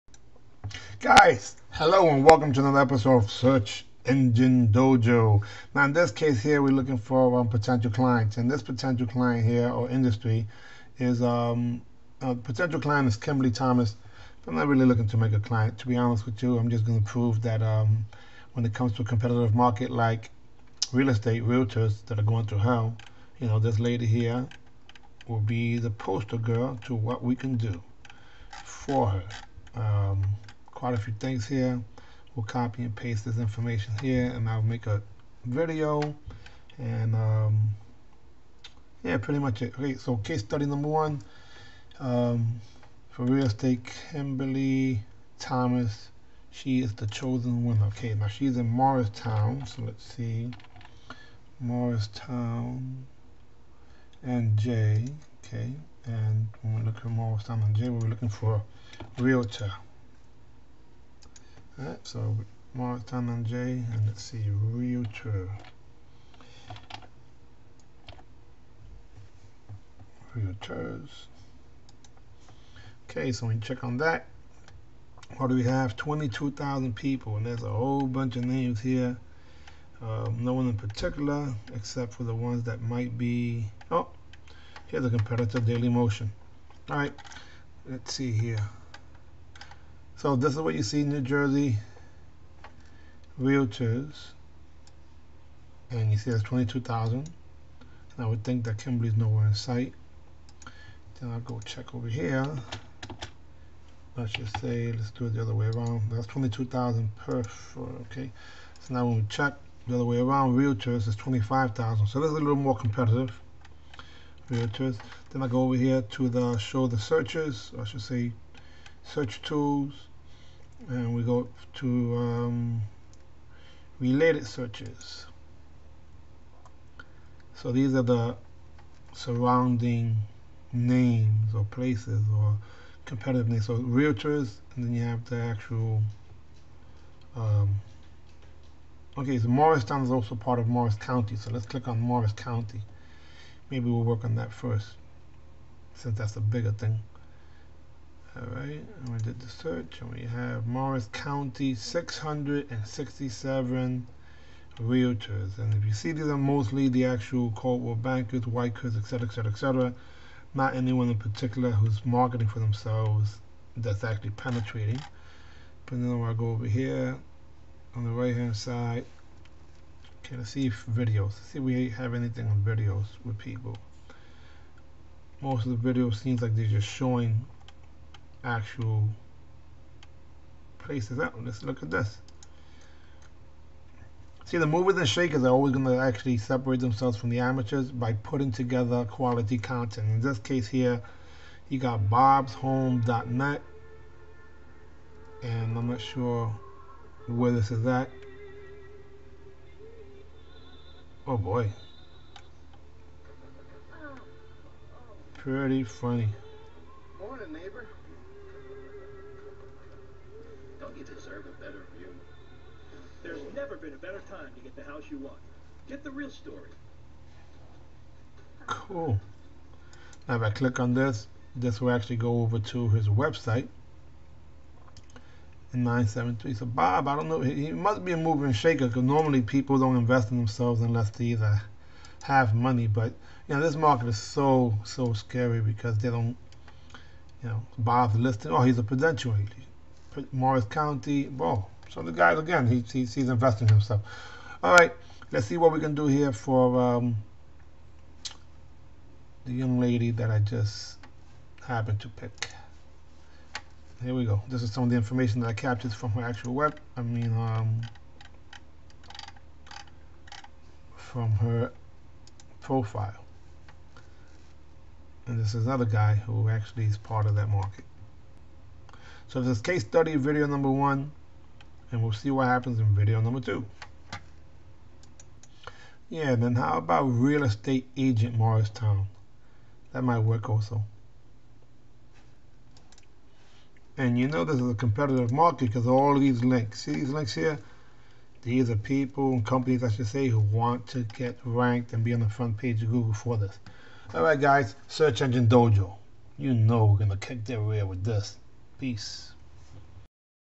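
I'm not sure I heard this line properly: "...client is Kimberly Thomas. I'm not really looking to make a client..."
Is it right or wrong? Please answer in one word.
right.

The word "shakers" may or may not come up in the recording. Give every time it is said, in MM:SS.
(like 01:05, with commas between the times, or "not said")
03:05, 03:48.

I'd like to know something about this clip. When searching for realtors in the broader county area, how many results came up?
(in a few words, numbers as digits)
667.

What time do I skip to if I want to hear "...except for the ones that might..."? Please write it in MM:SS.
01:21.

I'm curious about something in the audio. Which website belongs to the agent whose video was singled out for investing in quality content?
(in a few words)
bobshome.net.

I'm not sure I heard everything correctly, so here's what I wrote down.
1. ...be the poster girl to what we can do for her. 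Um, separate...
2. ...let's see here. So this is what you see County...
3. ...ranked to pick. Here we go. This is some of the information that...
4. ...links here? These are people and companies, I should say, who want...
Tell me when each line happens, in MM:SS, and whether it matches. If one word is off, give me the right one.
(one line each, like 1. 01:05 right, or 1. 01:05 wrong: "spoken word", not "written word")
1. 00:25 wrong: "quite", not "separate"
2. 01:27 wrong: "New", not "County"
3. 04:11 wrong: "happened", not "ranked"
4. 04:47 right.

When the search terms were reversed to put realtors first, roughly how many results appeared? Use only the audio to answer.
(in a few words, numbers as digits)
25,000.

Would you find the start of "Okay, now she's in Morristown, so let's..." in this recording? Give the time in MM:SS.
00:47.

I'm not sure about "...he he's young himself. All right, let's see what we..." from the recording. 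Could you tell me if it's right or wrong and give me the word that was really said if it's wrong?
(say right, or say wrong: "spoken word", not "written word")
wrong: "investing", not "young".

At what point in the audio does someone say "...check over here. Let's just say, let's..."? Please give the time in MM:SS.
01:41.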